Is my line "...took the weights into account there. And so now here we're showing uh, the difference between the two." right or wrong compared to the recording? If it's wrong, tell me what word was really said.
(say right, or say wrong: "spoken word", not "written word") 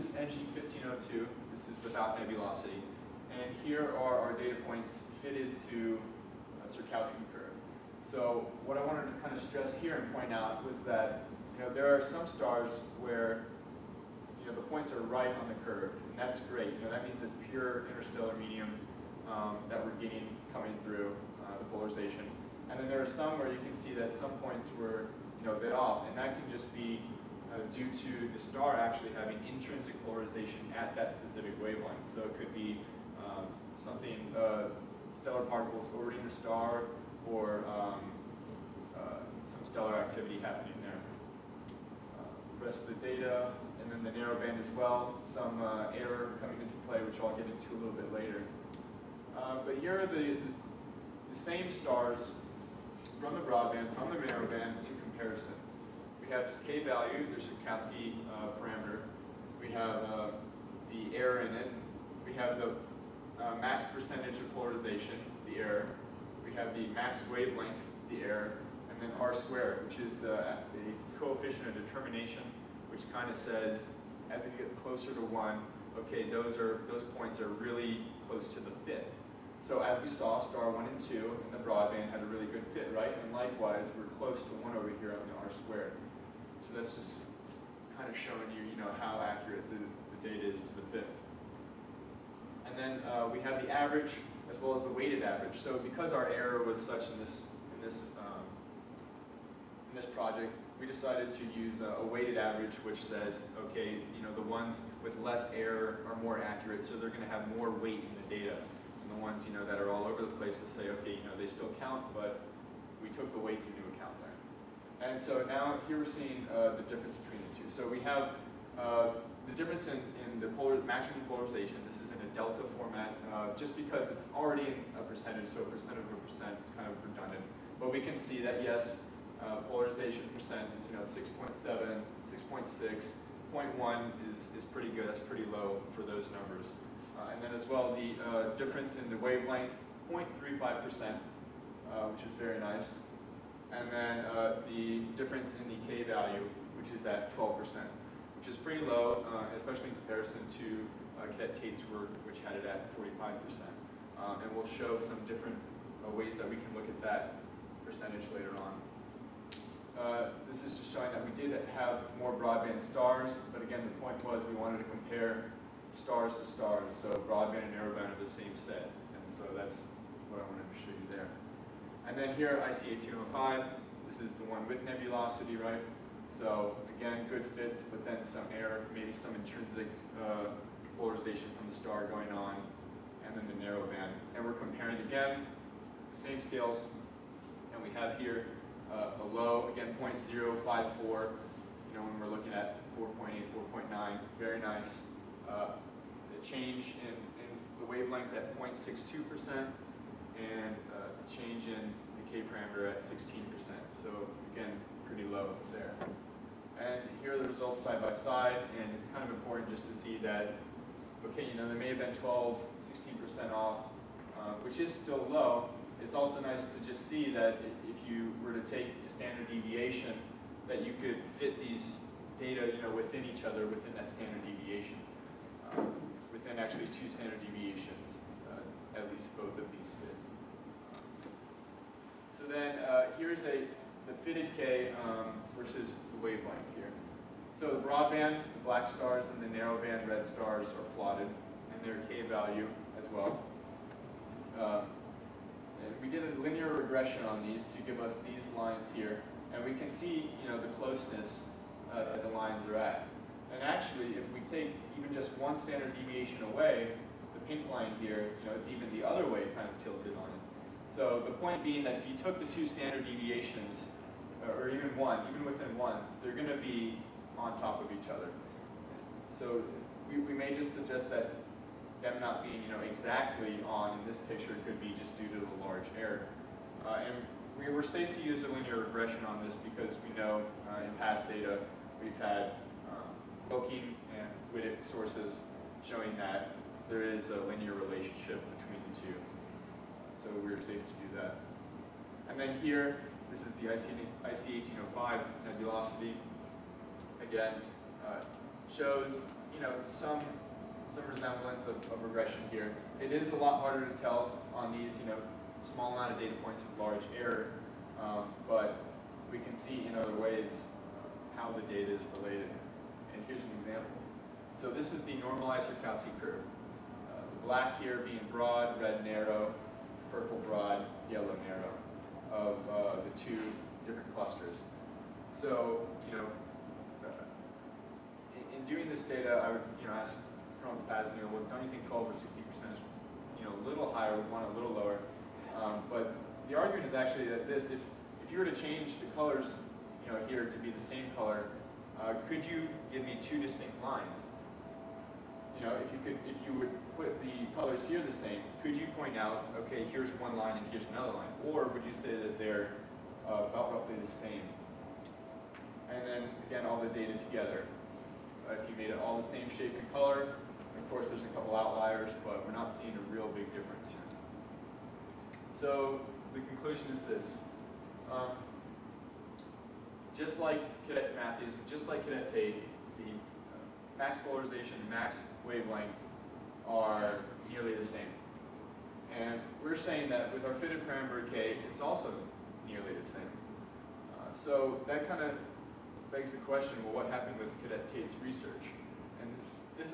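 wrong: "seeing", not "showing".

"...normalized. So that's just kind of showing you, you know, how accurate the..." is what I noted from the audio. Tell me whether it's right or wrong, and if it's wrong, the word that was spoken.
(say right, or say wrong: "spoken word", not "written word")
wrong: "squared", not "normalized".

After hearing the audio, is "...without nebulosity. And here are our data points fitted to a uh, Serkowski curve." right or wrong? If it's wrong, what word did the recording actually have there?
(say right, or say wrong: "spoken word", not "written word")
right.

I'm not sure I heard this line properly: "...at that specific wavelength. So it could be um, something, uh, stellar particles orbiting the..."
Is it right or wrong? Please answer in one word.
right.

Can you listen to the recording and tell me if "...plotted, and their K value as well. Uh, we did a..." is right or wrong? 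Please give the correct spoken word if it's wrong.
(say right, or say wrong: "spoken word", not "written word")
right.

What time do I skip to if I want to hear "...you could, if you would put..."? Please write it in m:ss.
5:45.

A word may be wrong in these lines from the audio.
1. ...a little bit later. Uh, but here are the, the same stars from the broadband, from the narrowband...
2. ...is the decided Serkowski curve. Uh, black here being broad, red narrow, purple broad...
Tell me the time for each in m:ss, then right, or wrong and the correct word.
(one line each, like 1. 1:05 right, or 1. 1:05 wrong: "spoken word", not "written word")
1. 0:47 right
2. 5:14 wrong: "normalized", not "decided".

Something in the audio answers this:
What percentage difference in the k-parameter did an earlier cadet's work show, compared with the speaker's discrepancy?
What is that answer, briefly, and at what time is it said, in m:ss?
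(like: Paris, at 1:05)
45%, at 2:32.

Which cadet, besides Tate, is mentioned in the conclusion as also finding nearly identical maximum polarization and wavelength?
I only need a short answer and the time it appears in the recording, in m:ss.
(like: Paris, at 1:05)
Cadet Matthews, at 6:10.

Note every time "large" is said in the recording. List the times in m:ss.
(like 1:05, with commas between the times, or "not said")
4:35, 5:06.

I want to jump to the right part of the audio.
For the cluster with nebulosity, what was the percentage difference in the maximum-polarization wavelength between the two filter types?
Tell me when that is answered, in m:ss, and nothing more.
3:18.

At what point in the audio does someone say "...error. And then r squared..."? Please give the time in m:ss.
1:08.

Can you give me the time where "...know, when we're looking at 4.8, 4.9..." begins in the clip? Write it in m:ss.
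3:11.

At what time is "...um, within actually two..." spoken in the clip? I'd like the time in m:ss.
3:45.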